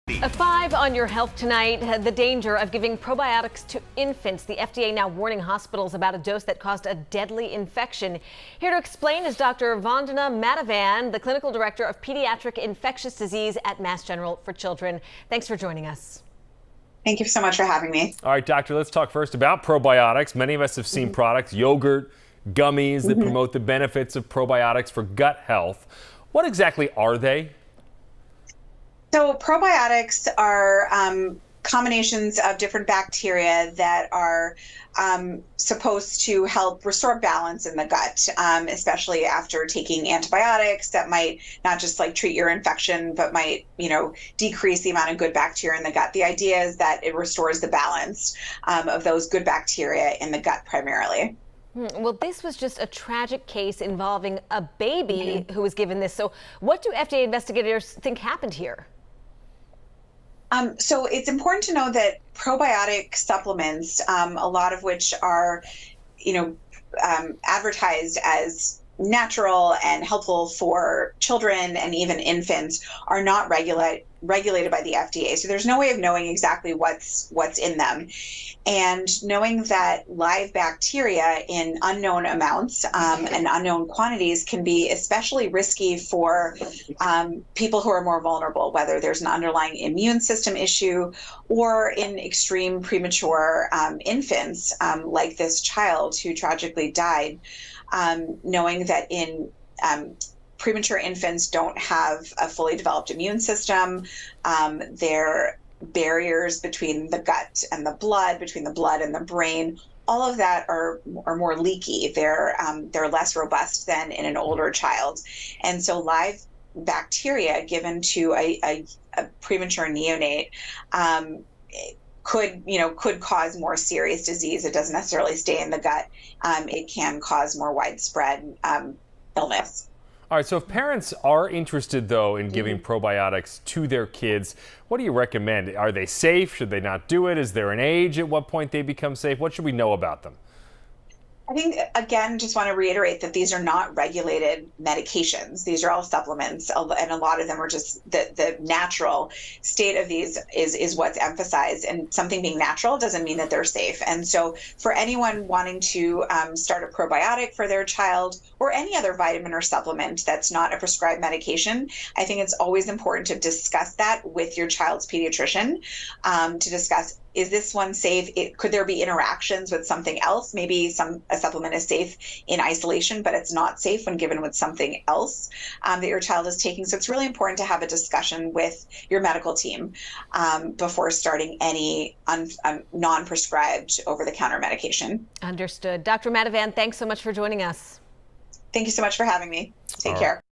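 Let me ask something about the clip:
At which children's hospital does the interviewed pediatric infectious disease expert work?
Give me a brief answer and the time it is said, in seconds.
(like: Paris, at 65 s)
Mass General for Children, at 13 s.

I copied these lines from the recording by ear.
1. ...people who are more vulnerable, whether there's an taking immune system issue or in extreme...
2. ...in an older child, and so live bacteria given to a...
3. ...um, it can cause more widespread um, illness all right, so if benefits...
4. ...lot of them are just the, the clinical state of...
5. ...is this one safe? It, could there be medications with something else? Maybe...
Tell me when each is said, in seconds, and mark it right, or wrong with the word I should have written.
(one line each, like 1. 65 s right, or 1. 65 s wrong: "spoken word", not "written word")
1. 87 s wrong: "underlying", not "taking"
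2. 114 s right
3. 126 s wrong: "parents", not "benefits"
4. 147 s wrong: "natural", not "clinical"
5. 167 s wrong: "interactions", not "medications".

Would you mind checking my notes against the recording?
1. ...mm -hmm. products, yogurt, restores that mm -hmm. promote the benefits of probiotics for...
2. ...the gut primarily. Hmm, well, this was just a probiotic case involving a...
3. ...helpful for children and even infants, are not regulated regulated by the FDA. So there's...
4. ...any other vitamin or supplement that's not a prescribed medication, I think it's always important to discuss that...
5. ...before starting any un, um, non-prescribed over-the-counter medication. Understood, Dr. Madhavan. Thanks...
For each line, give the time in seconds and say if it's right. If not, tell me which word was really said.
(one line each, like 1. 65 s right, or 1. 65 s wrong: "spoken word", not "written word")
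1. 21 s wrong: "gummies", not "restores"
2. 50 s wrong: "tragic", not "probiotic"
3. 70 s right
4. 158 s right
5. 180 s right.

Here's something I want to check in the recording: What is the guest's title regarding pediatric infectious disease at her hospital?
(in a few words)
Clinical director.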